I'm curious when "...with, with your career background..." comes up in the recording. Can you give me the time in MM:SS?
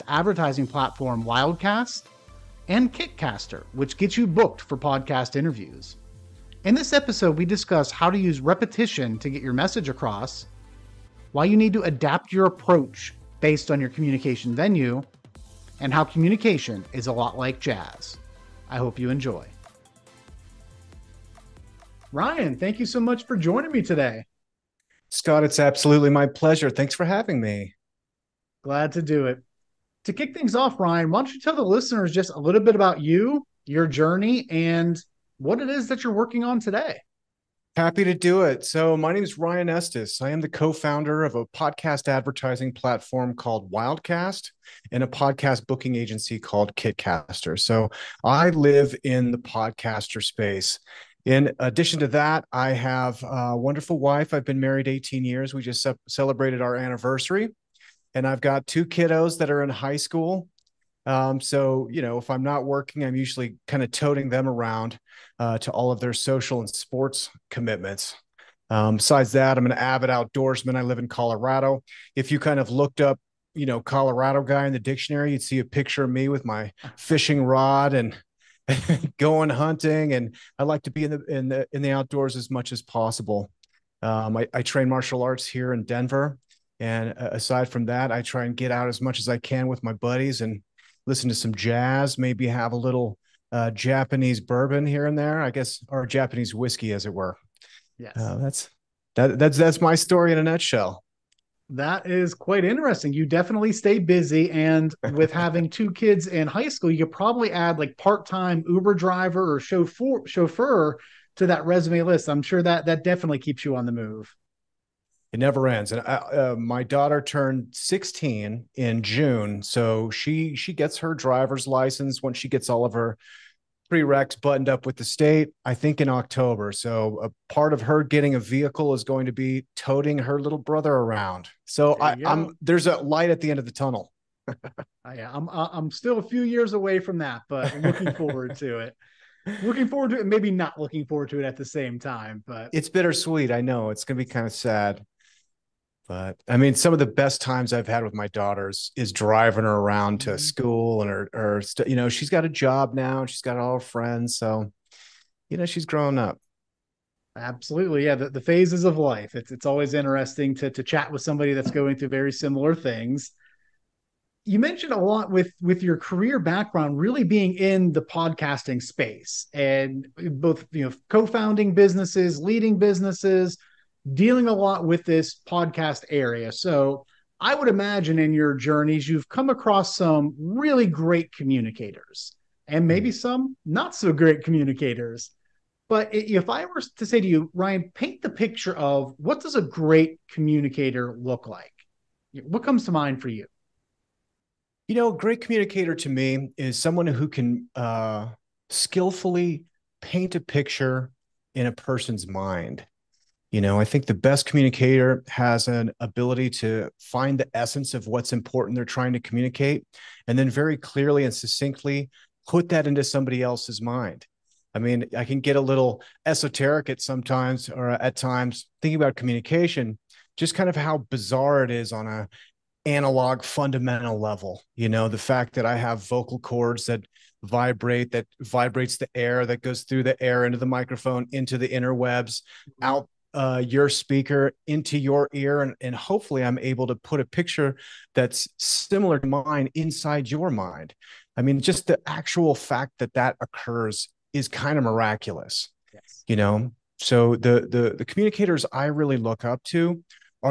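02:45.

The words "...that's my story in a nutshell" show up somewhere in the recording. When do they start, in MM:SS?
01:39.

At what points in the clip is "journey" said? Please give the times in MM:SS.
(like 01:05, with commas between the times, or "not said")
00:33, 02:58.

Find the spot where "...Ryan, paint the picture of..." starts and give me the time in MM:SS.
03:07.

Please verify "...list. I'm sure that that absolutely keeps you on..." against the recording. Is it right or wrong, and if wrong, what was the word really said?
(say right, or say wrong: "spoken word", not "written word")
wrong: "definitely", not "absolutely".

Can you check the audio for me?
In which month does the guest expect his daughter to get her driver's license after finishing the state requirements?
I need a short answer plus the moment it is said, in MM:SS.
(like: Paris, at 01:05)
October, at 02:06.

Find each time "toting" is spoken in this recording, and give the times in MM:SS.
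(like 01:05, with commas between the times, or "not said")
01:03, 02:09.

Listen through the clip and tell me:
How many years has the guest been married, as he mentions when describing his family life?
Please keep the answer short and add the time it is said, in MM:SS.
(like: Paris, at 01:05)
18, at 00:54.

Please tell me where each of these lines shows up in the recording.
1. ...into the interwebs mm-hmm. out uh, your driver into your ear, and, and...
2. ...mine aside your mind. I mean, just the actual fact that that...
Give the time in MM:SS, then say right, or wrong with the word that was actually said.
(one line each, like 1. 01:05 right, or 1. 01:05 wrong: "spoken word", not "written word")
1. 03:51 wrong: "speaker", not "driver"
2. 03:59 wrong: "inside", not "aside".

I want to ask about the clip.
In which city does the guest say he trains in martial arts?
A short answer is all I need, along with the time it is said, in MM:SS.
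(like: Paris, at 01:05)
Denver, at 01:25.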